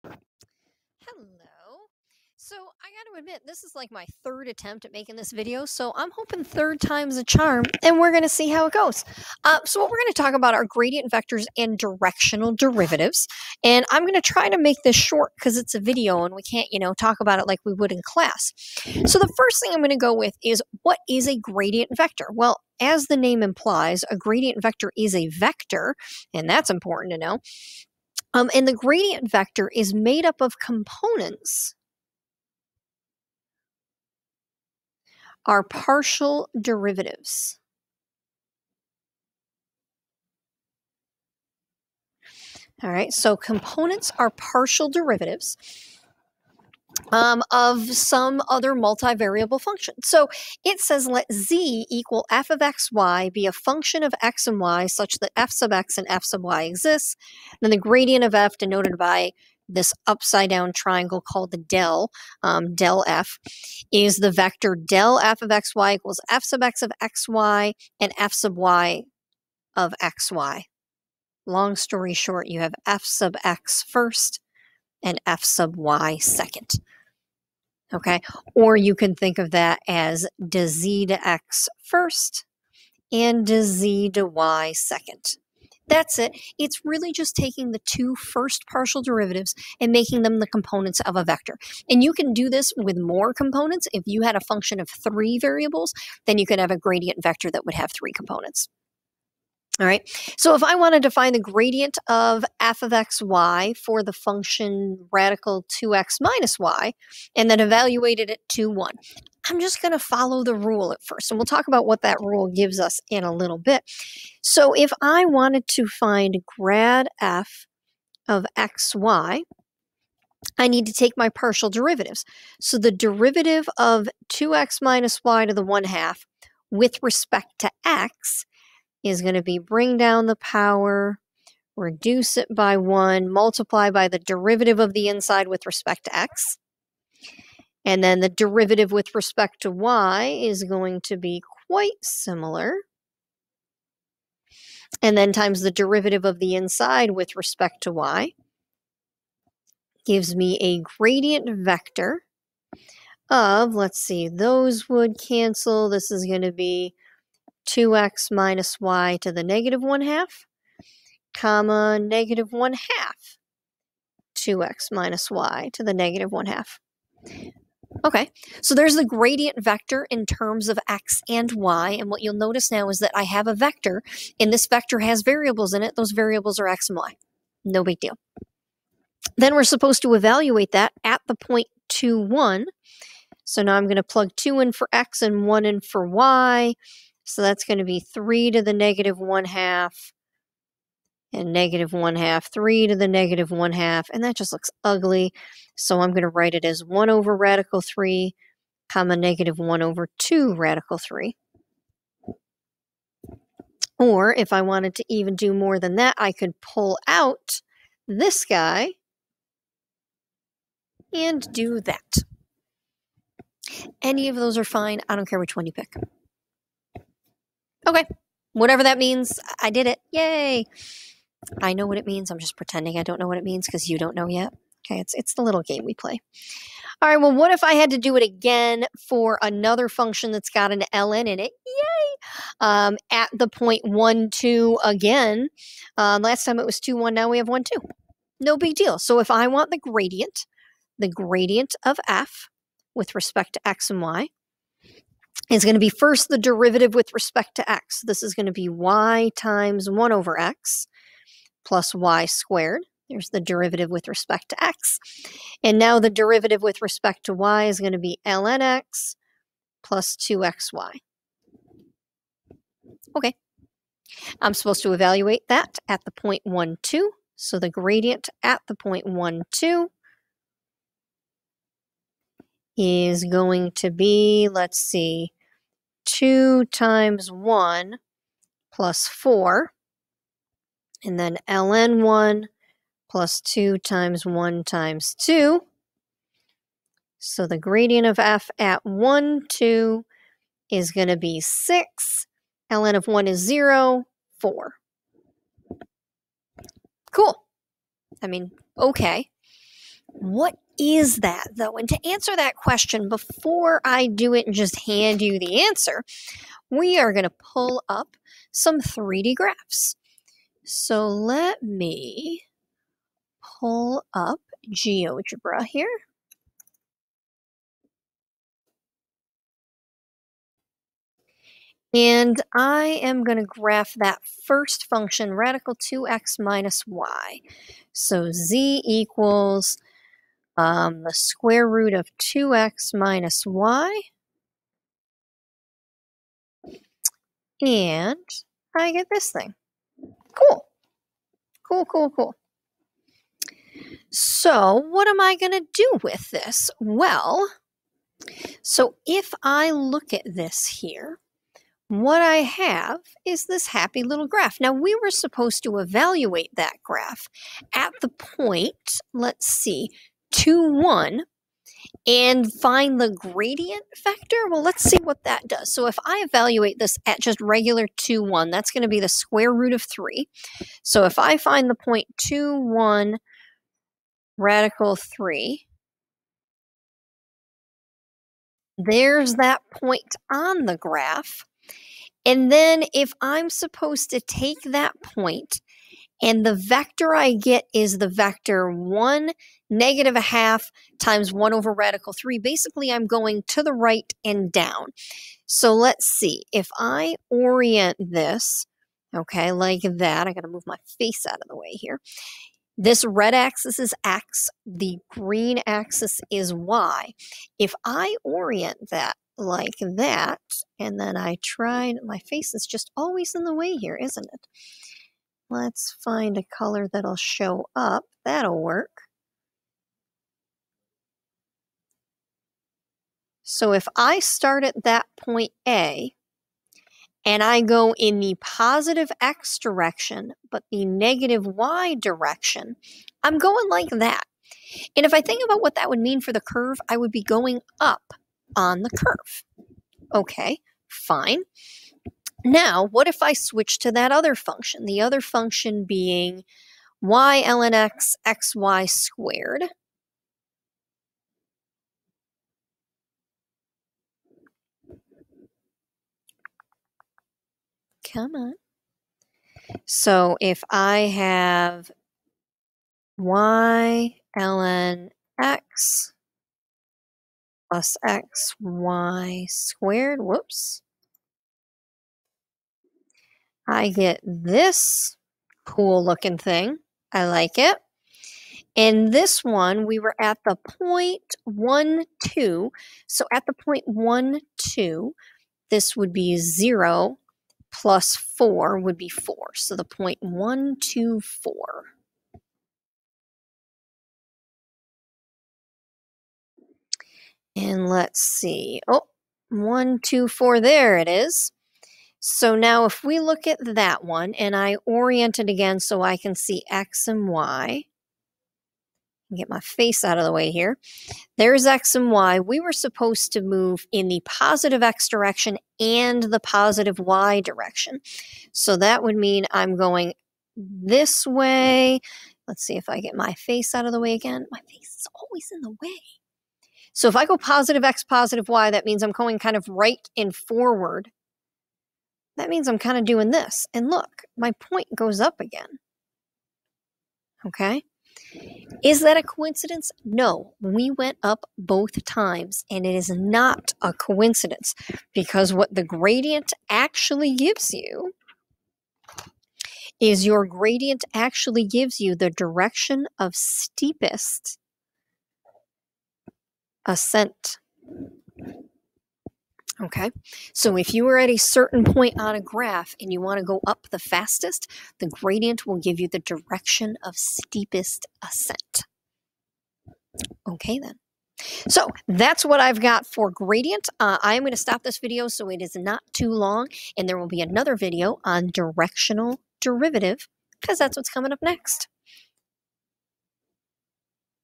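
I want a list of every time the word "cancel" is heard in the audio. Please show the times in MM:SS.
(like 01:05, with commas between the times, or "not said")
02:35.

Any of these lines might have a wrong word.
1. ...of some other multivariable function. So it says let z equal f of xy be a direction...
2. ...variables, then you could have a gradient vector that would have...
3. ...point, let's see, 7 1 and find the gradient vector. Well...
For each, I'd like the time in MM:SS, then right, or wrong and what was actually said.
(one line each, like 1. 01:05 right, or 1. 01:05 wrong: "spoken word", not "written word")
1. 00:47 wrong: "function", not "direction"
2. 01:35 right
3. 05:58 wrong: "2", not "7".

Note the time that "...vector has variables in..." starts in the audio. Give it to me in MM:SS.
02:54.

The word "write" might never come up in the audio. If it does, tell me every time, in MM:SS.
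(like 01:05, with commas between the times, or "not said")
03:16.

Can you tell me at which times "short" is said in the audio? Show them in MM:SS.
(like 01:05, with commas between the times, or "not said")
00:14, 01:12.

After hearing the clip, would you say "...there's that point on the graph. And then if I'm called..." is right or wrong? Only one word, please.
wrong.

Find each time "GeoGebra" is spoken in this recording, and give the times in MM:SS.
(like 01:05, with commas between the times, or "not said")
05:14.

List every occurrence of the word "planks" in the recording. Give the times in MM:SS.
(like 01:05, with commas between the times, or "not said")
not said.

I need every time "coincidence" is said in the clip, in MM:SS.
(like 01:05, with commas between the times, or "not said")
08:59, 09:03.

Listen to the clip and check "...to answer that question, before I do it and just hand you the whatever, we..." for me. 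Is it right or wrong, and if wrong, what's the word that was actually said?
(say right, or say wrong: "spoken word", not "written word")
wrong: "answer", not "whatever".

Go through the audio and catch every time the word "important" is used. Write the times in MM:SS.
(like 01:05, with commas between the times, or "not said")
00:26.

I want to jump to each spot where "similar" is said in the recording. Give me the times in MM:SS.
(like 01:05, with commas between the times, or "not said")
02:22.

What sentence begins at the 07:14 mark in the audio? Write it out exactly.
And if I think about what that would mean for the curve, I would be going up on the curve.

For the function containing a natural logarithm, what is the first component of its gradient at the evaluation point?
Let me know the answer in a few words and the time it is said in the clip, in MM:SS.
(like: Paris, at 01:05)
6, at 04:51.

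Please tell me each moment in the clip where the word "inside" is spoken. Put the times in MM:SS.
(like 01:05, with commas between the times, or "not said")
02:15, 02:26.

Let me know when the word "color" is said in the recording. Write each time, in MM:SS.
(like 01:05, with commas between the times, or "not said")
06:56.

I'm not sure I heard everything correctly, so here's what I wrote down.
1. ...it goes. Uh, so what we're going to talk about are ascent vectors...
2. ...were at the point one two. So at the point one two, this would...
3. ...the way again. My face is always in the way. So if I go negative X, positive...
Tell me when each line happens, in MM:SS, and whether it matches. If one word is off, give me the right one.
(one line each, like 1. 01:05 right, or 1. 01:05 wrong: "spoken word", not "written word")
1. 00:08 wrong: "gradient", not "ascent"
2. 07:59 right
3. 08:43 wrong: "positive", not "negative".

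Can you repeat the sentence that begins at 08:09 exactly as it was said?
So the point one two four.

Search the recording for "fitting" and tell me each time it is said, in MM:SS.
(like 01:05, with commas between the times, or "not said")
not said.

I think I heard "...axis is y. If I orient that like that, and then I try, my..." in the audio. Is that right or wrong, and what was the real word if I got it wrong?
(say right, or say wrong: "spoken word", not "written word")
right.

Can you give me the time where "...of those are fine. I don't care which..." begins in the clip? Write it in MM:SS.
03:34.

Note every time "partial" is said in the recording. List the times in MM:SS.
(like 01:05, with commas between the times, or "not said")
00:35, 00:44, 01:28, 02:01.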